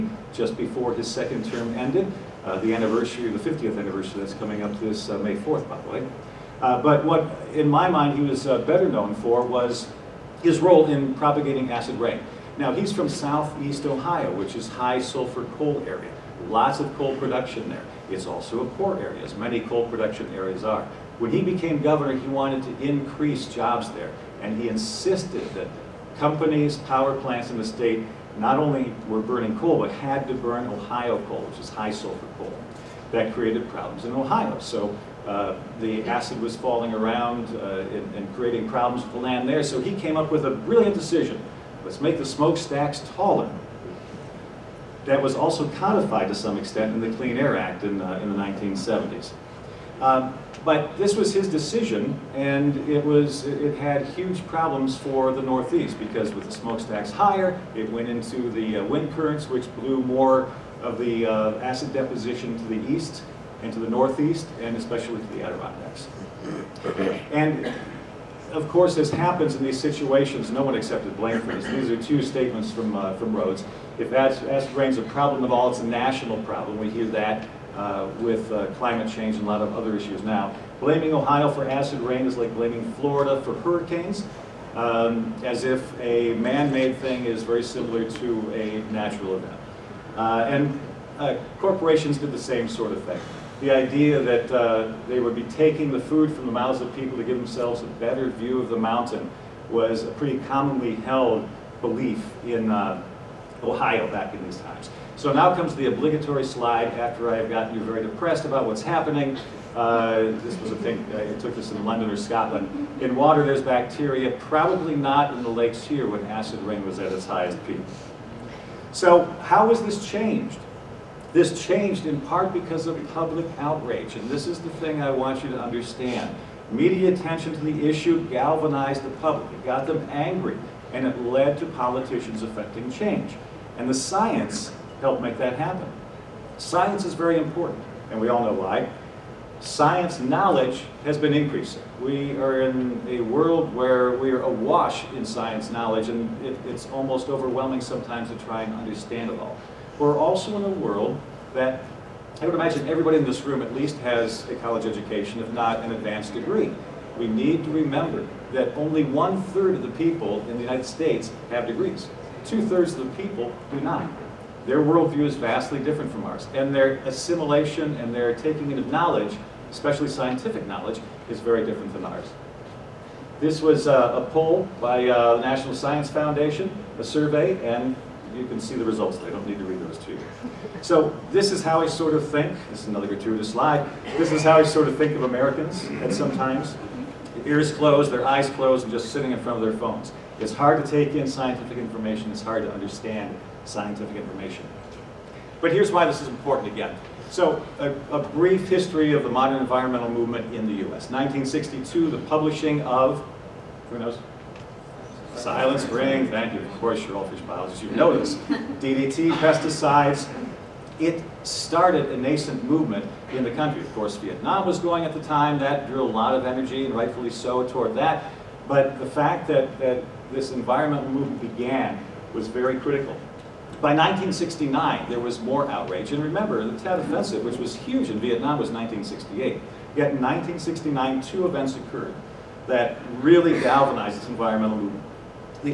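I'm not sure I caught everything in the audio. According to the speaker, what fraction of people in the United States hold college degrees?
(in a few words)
one-third.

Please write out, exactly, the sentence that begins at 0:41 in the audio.
Let's make the smokestacks taller that was also codified to some extent in the Clean Air Act in, uh, in the 1970s.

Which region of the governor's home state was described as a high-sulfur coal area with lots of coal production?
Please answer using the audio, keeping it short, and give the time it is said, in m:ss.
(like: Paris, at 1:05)
southeast Ohio, at 0:13.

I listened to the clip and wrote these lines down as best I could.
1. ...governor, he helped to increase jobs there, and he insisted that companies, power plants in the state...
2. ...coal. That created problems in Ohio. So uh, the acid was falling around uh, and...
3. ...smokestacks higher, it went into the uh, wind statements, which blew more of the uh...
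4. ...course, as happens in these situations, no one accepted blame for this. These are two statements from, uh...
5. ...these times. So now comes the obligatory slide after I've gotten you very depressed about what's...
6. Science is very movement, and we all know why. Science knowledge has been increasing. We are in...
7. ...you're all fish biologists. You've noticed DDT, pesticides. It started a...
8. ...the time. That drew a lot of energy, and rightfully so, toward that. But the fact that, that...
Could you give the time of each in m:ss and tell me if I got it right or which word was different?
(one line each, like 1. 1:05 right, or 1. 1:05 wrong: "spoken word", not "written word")
1. 0:21 wrong: "wanted", not "helped"
2. 0:32 right
3. 0:56 wrong: "currents", not "statements"
4. 1:08 right
5. 1:44 right
6. 2:16 wrong: "important", not "movement"
7. 3:27 right
8. 3:35 right.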